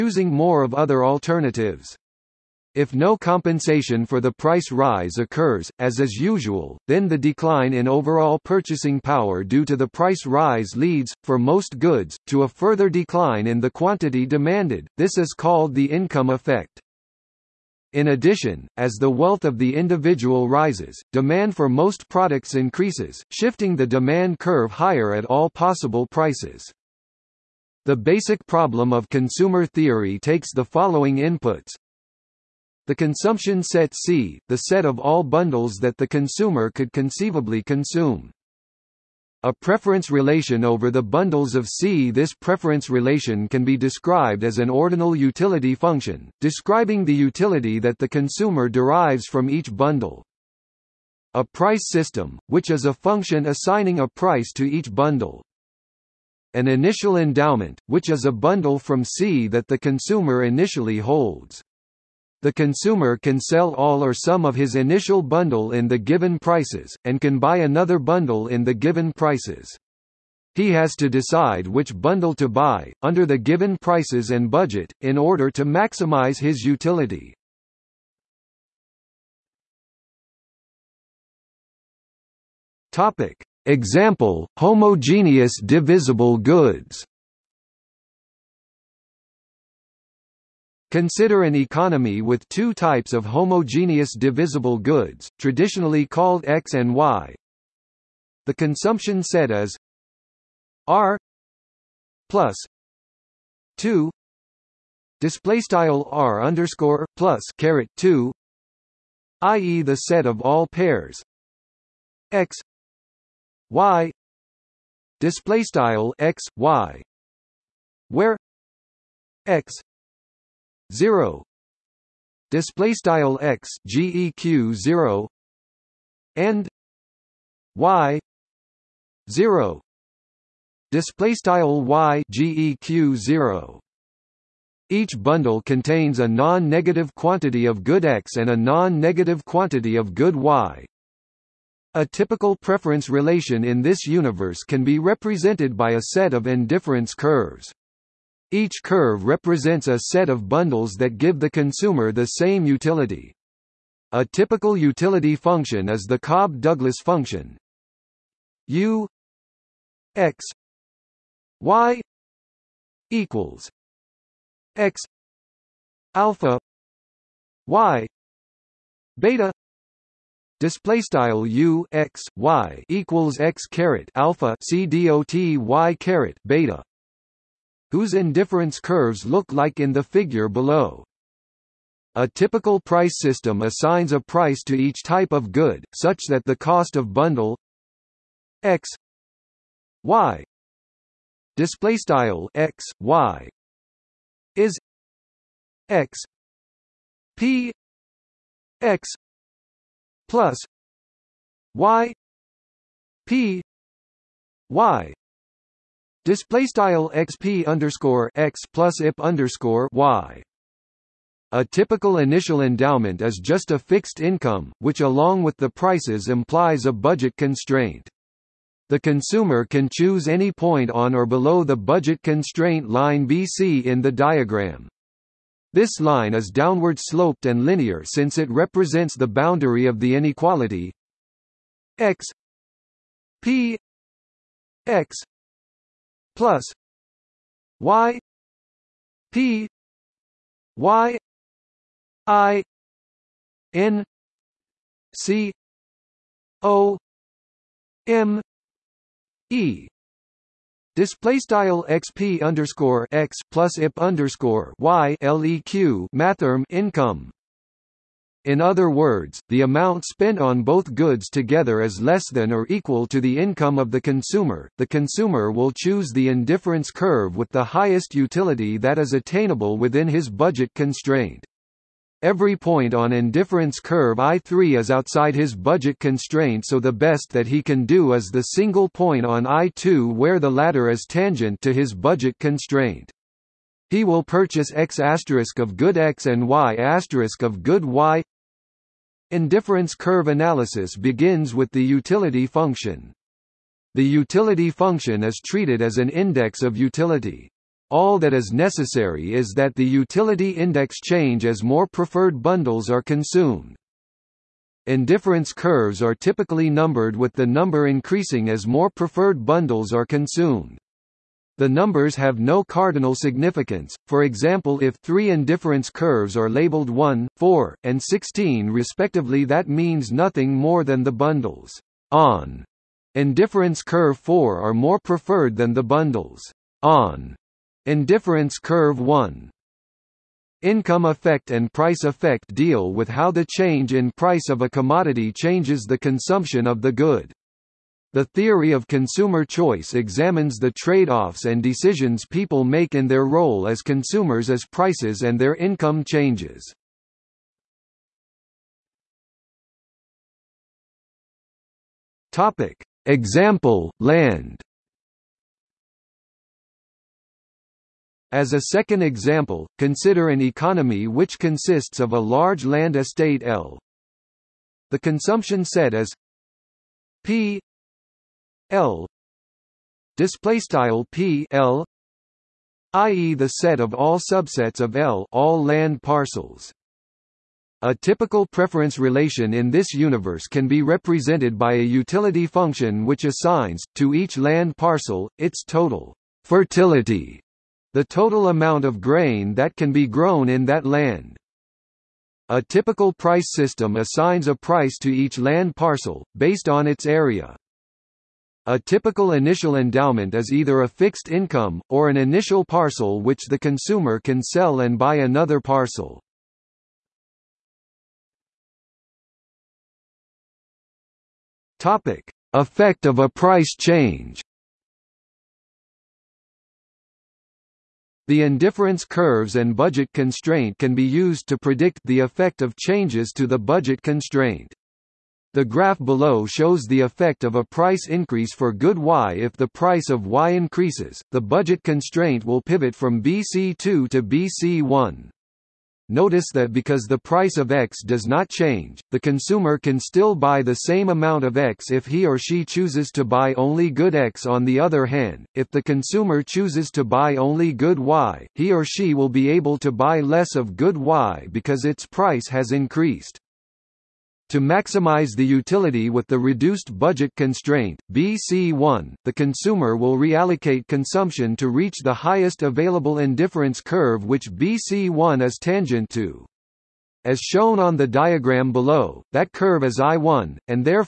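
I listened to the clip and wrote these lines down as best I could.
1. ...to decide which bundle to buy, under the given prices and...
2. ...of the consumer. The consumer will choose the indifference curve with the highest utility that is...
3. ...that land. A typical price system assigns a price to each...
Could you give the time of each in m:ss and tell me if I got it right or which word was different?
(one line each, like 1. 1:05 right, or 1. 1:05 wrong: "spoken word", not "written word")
1. 1:10 right
2. 4:23 right
3. 6:30 right.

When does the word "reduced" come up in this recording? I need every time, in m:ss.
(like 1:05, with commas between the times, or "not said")
7:36.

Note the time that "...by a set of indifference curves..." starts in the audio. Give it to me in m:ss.
2:25.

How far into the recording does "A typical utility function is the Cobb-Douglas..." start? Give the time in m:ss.
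2:34.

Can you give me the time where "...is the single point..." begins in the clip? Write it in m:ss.
4:38.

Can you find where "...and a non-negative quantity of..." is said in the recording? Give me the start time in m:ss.
2:18.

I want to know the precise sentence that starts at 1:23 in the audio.
Example, homogeneous divisible goods Consider an economy with two types of homogeneous divisible goods, traditionally called X and Y.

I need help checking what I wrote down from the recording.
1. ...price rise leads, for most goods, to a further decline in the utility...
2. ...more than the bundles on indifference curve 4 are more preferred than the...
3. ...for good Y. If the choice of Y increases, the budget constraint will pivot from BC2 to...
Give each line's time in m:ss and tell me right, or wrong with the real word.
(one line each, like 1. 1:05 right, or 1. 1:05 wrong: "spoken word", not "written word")
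1. 0:09 wrong: "quantity", not "utility"
2. 5:20 right
3. 7:08 wrong: "price", not "choice".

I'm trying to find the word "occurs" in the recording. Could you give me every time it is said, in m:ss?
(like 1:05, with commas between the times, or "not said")
0:05.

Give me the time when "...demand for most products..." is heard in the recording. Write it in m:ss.
0:21.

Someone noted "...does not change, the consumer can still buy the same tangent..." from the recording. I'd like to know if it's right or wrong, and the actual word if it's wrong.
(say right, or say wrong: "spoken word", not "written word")
wrong: "amount", not "tangent".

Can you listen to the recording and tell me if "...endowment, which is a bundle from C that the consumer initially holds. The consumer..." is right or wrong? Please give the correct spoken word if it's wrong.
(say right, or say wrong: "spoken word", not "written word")
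right.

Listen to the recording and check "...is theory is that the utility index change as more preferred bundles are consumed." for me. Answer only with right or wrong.
wrong.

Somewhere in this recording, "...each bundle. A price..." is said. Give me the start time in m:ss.
0:49.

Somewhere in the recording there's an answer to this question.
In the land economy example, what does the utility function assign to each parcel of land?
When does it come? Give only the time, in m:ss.
6:25.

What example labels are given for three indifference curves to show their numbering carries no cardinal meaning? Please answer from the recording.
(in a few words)
1, 4, and 16.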